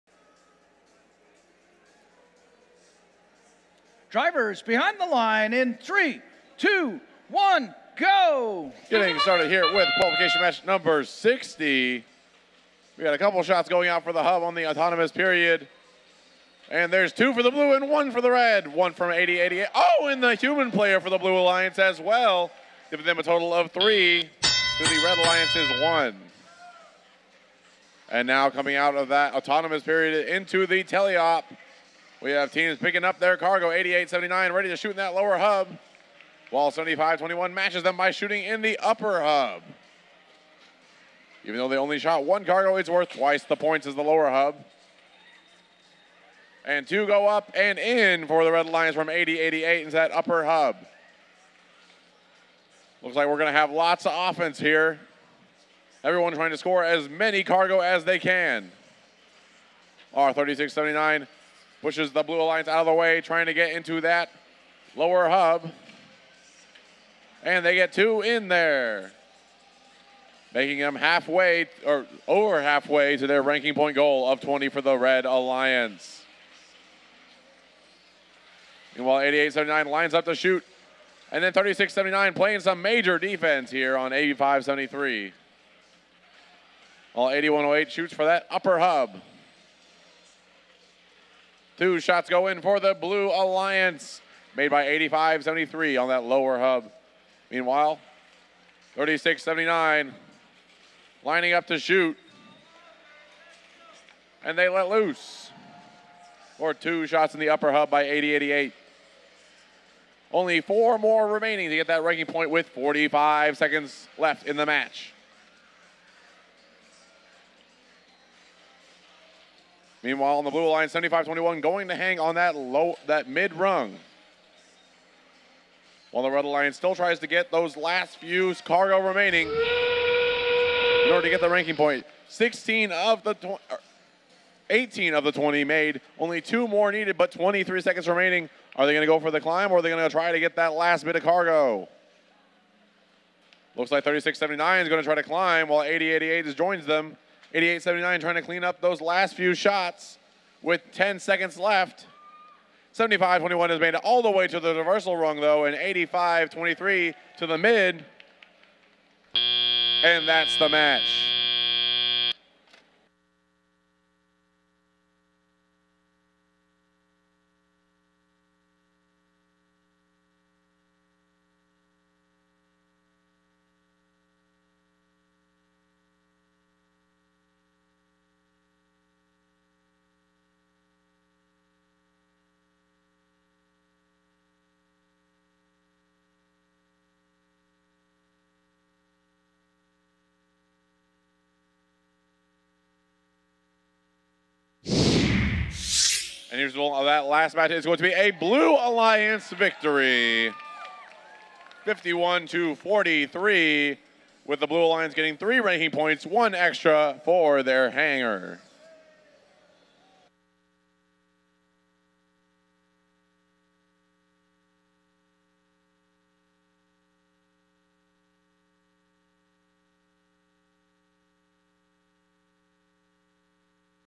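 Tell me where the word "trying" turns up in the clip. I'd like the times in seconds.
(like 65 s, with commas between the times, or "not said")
56 s, 63 s, 148 s.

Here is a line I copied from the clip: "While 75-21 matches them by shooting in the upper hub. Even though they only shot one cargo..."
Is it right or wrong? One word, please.
right.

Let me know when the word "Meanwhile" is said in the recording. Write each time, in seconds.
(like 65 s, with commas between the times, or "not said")
78 s, 97 s, 120 s.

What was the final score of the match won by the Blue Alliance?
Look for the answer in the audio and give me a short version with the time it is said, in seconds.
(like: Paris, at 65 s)
51 to 43, at 201 s.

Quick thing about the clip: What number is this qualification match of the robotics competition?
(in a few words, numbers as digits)
60.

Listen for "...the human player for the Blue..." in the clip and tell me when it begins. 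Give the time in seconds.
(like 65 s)
20 s.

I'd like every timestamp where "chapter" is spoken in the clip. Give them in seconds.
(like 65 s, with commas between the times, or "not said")
not said.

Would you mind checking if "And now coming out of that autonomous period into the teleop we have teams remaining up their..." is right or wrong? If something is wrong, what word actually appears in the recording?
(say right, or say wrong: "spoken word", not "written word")
wrong: "picking", not "remaining".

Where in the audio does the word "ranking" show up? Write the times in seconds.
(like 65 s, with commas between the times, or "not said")
73 s, 112 s, 131 s, 205 s.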